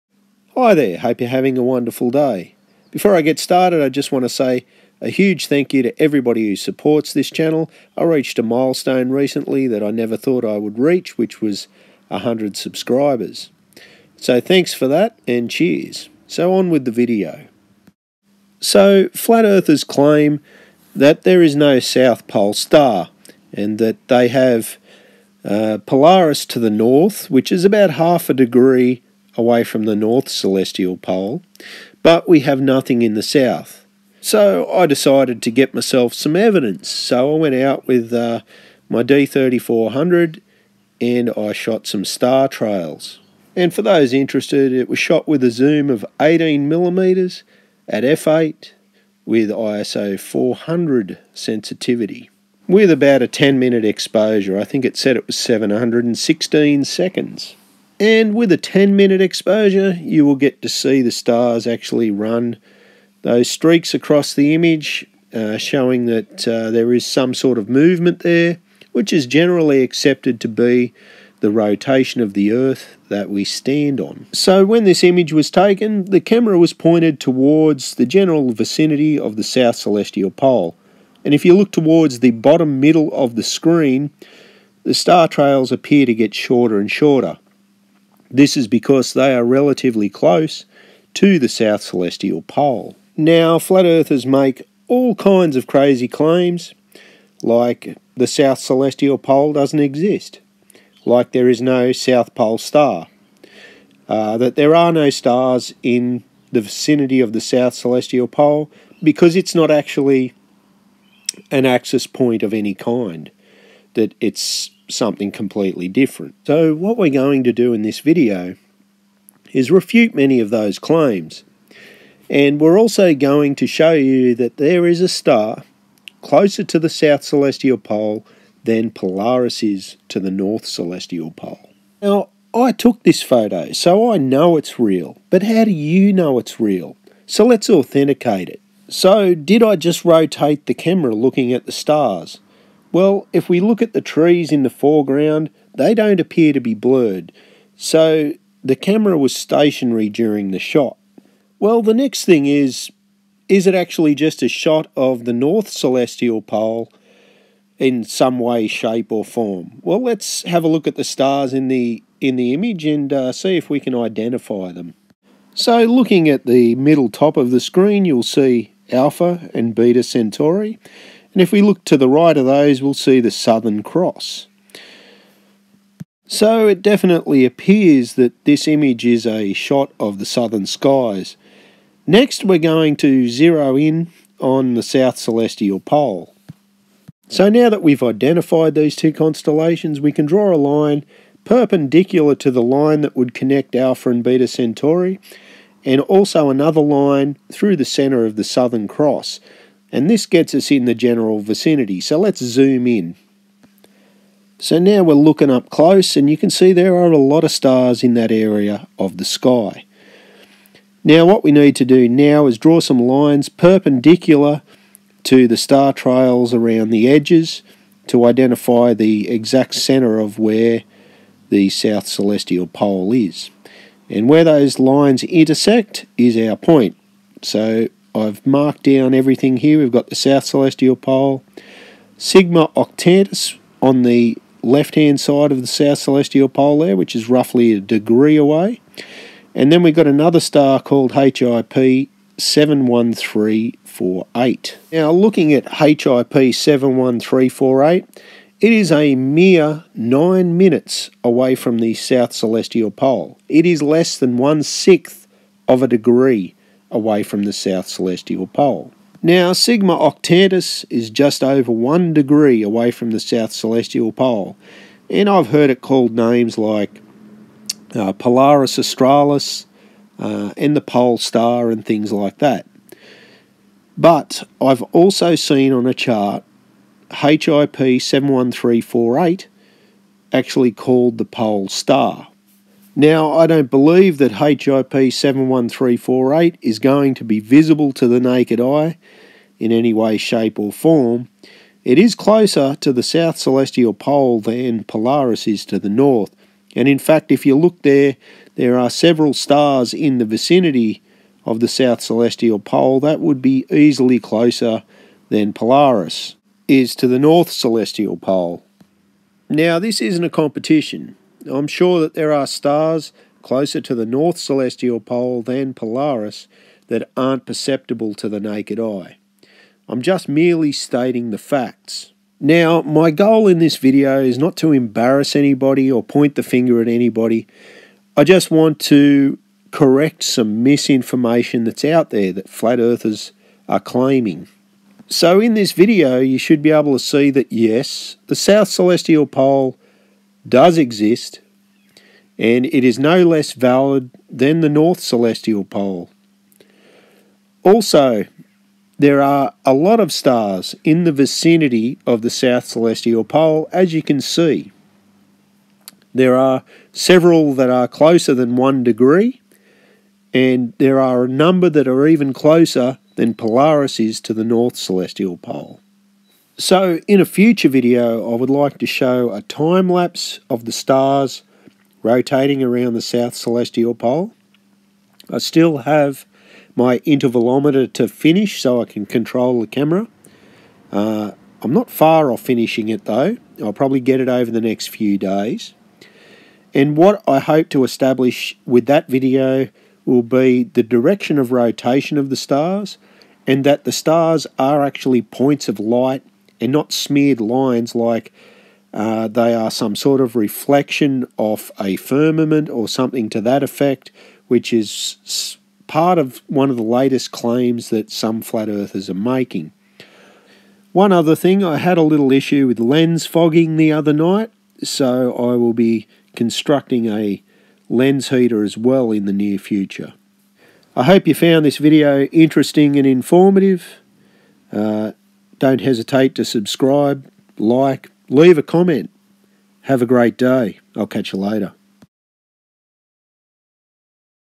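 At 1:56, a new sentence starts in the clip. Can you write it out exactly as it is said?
So what we're going to do in this video is refute many of those claims.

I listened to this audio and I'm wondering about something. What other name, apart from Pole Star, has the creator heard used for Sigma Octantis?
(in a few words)
Polaris Australis.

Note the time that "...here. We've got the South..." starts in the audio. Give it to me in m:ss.
3:49.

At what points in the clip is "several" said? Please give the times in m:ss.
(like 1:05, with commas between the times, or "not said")
4:58, 5:56.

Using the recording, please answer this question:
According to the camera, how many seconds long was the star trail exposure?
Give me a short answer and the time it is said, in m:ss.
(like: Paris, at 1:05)
716, at 0:55.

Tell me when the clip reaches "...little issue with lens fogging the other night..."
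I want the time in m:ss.
6:52.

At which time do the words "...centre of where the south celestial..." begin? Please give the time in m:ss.
3:39.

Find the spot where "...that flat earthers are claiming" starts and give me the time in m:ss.
5:32.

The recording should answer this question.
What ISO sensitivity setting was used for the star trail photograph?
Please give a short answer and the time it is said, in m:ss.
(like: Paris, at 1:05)
400, at 0:49.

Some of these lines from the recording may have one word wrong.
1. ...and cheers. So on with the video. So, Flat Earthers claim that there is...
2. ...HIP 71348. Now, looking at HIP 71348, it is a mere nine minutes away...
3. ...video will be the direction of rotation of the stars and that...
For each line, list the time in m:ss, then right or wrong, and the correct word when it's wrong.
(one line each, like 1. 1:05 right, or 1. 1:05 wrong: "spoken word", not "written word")
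1. 0:15 right
2. 4:01 right
3. 6:29 right.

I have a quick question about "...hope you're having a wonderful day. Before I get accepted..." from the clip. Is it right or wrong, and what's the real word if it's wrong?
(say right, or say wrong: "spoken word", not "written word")
wrong: "started", not "accepted".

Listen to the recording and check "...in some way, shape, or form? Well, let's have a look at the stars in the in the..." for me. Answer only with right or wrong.
right.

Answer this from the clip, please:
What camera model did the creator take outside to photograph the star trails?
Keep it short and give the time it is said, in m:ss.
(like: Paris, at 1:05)
D3400, at 0:39.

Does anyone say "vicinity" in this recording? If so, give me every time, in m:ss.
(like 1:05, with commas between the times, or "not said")
1:18, 1:46, 3:21, 5:00, 5:51.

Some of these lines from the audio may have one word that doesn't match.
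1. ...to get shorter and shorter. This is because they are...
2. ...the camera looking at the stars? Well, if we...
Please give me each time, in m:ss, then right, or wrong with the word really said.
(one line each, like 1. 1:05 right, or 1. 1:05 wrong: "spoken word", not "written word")
1. 1:26 right
2. 2:20 right.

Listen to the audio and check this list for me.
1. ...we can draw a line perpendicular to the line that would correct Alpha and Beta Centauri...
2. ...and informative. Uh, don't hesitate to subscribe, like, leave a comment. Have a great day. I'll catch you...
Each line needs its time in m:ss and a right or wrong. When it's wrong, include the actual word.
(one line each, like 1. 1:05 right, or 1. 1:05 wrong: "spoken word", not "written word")
1. 3:09 wrong: "connect", not "correct"
2. 7:02 right.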